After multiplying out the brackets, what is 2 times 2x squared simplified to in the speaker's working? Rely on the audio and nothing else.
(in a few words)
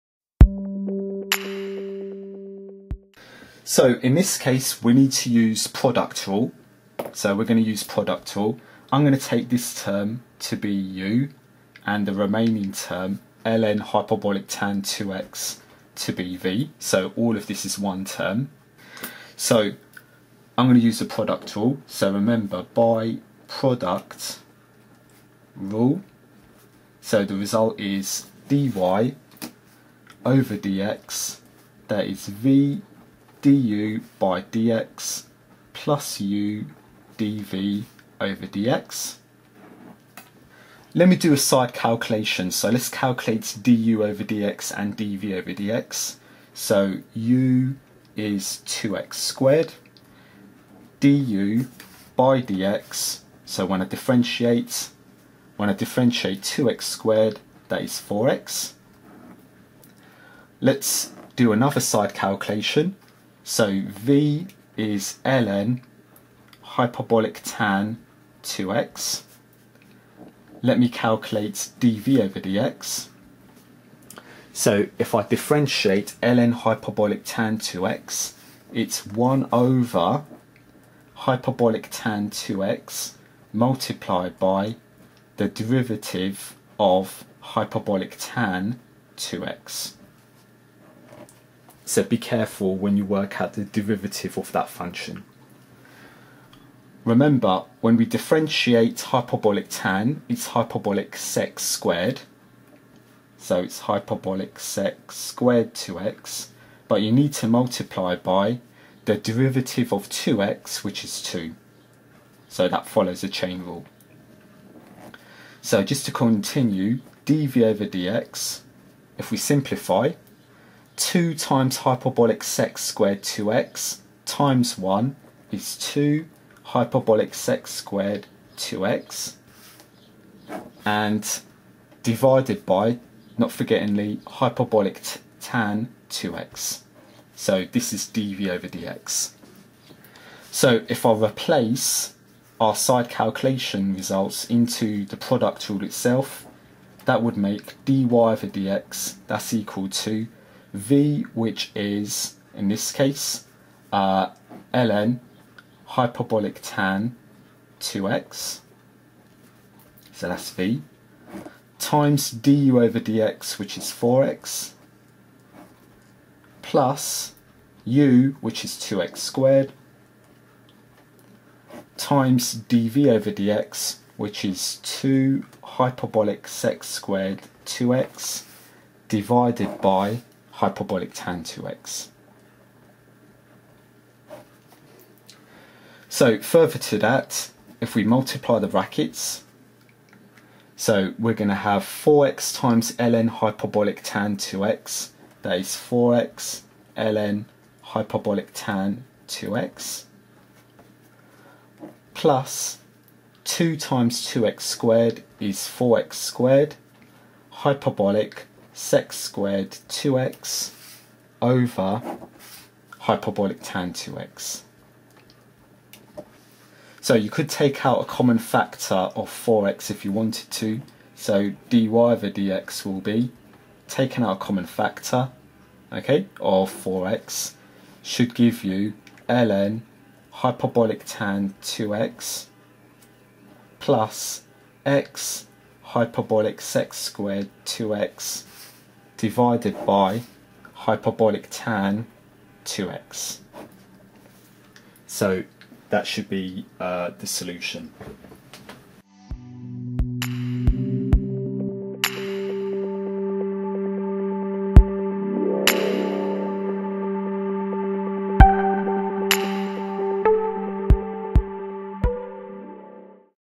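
4x squared.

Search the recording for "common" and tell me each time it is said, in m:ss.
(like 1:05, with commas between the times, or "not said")
3:38, 3:44.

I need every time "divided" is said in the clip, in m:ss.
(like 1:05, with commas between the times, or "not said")
2:12, 2:59, 3:59.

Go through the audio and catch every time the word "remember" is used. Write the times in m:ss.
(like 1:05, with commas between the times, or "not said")
0:22, 1:37.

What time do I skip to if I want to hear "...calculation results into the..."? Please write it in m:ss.
2:23.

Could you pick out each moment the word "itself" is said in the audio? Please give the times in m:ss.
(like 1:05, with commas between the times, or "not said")
2:25.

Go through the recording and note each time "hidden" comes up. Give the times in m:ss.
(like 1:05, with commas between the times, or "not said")
not said.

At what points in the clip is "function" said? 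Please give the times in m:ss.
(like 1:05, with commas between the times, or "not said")
1:34.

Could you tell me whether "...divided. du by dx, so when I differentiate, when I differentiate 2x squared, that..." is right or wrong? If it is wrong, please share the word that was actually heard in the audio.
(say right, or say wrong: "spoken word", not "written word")
wrong: "squared", not "divided".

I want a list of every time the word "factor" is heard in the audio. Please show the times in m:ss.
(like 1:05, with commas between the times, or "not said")
3:38, 3:44.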